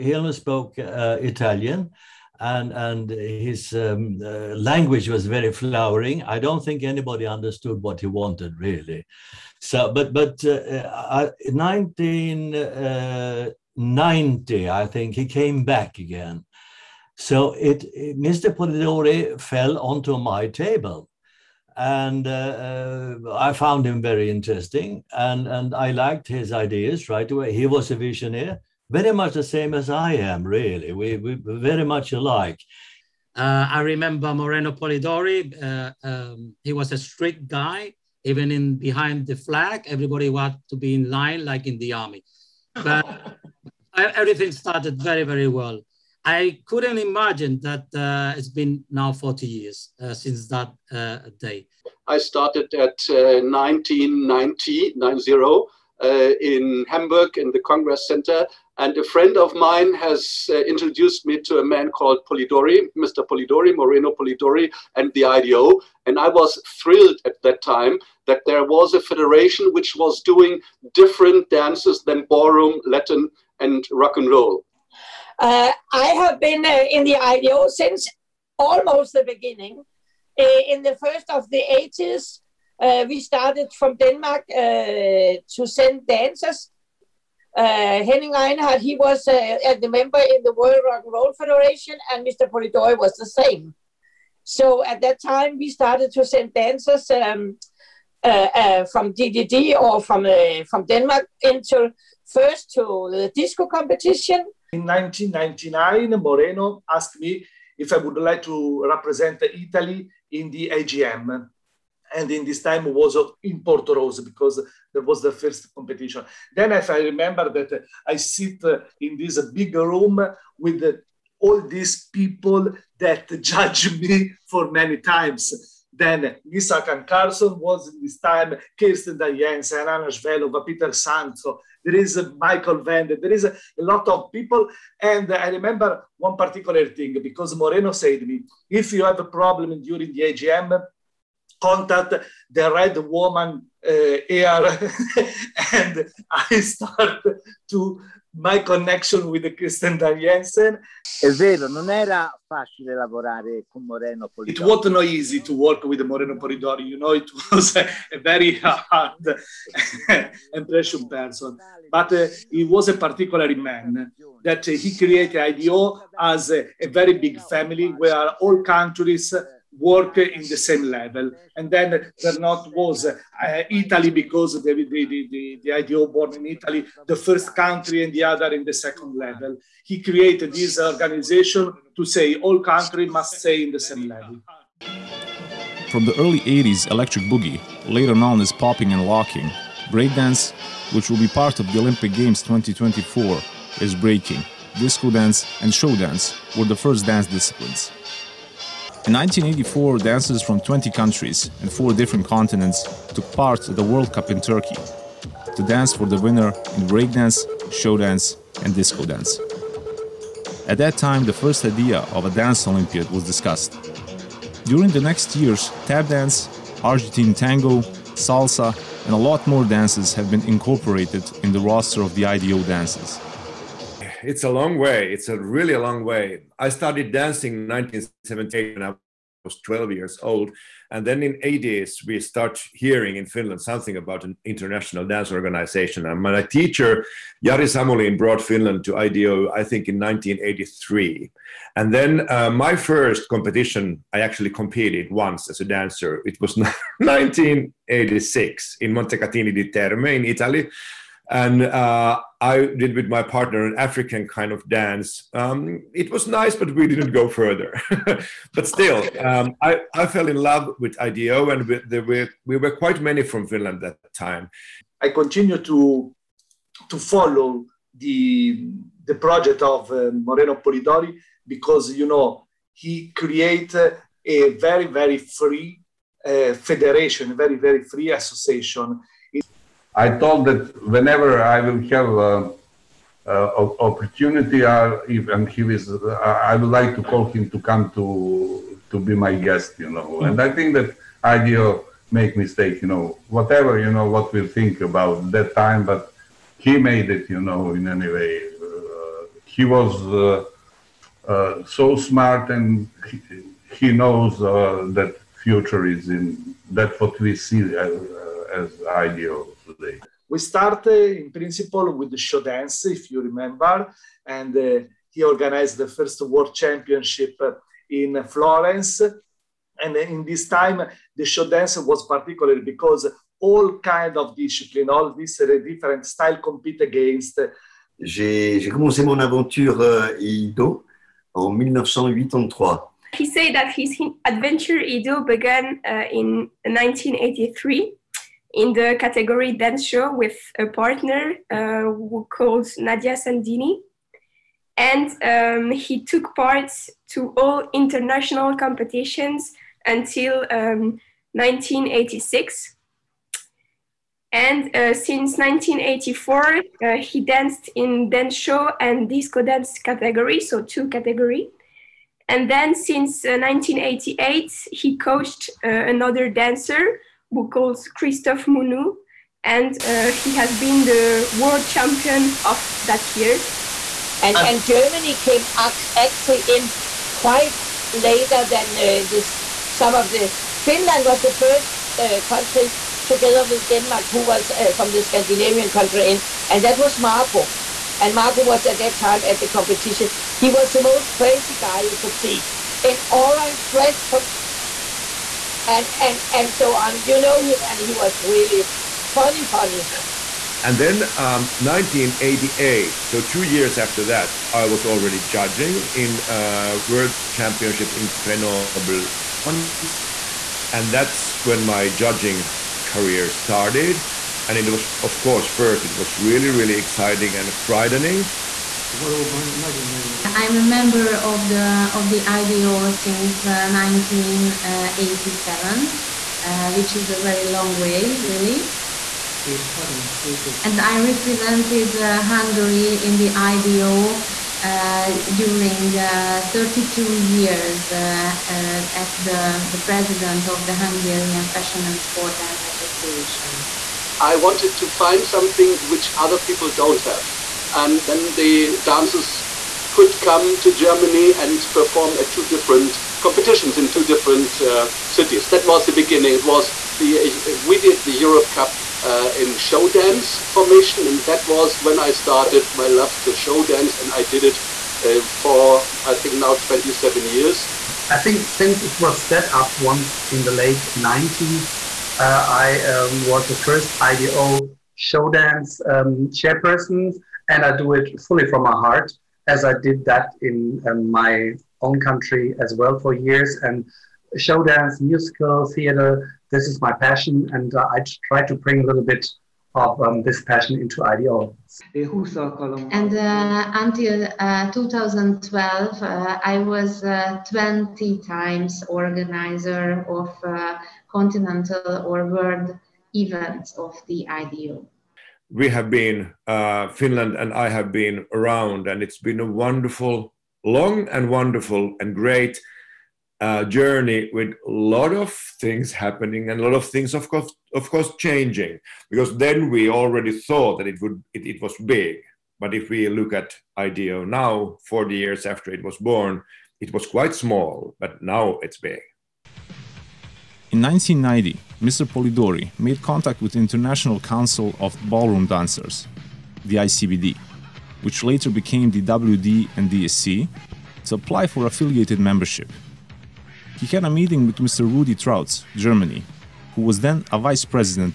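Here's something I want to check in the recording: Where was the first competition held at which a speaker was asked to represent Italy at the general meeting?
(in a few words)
Porto Rose.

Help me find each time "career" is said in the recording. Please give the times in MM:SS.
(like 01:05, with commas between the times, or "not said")
06:52.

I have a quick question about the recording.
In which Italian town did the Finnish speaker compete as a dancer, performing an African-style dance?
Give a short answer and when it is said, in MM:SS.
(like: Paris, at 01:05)
Montecatini di Terme, at 04:08.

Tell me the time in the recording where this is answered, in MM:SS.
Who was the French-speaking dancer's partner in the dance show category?
05:42.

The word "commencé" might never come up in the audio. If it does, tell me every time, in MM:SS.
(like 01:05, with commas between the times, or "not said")
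05:28.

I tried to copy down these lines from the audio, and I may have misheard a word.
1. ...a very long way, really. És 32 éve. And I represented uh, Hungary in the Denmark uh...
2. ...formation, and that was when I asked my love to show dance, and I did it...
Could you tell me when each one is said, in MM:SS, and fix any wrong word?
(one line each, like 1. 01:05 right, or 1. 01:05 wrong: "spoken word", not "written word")
1. 07:07 wrong: "IDO", not "Denmark"
2. 07:40 wrong: "started", not "asked".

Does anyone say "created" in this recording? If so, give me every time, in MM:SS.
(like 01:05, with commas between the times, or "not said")
02:44, 03:00, 04:33.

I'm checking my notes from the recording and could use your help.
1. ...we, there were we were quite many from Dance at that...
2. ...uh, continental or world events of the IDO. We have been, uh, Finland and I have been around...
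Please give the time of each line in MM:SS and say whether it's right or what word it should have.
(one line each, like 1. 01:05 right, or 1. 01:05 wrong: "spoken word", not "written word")
1. 04:21 wrong: "Finland", not "Dance"
2. 08:20 right.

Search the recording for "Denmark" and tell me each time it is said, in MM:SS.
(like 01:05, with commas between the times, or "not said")
01:23, 01:40, 06:23.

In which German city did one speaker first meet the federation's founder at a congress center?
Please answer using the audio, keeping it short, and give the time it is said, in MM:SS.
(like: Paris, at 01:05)
Hamburg, at 00:56.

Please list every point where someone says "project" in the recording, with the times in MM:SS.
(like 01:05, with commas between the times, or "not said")
04:29.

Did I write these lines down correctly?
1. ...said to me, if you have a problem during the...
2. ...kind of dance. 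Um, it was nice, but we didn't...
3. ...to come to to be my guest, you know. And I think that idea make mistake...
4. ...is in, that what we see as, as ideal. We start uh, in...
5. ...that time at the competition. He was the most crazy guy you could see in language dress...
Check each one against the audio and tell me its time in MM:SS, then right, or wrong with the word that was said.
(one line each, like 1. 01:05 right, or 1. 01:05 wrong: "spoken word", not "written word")
1. 02:17 right
2. 04:14 right
3. 04:47 right
4. 05:05 right
5. 06:28 wrong: "orange", not "language".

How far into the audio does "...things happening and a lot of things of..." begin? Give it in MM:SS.
08:35.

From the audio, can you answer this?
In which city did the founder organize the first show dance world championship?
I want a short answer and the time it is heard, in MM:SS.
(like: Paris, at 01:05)
Florence, at 05:17.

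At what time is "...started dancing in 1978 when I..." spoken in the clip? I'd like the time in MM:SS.
03:46.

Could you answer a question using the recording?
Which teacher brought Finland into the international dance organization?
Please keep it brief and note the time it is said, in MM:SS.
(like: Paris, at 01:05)
Jari Samulin, at 03:57.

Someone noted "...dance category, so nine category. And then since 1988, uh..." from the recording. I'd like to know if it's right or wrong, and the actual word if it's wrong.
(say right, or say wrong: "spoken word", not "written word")
wrong: "two", not "nine".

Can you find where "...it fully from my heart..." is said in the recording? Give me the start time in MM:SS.
07:57.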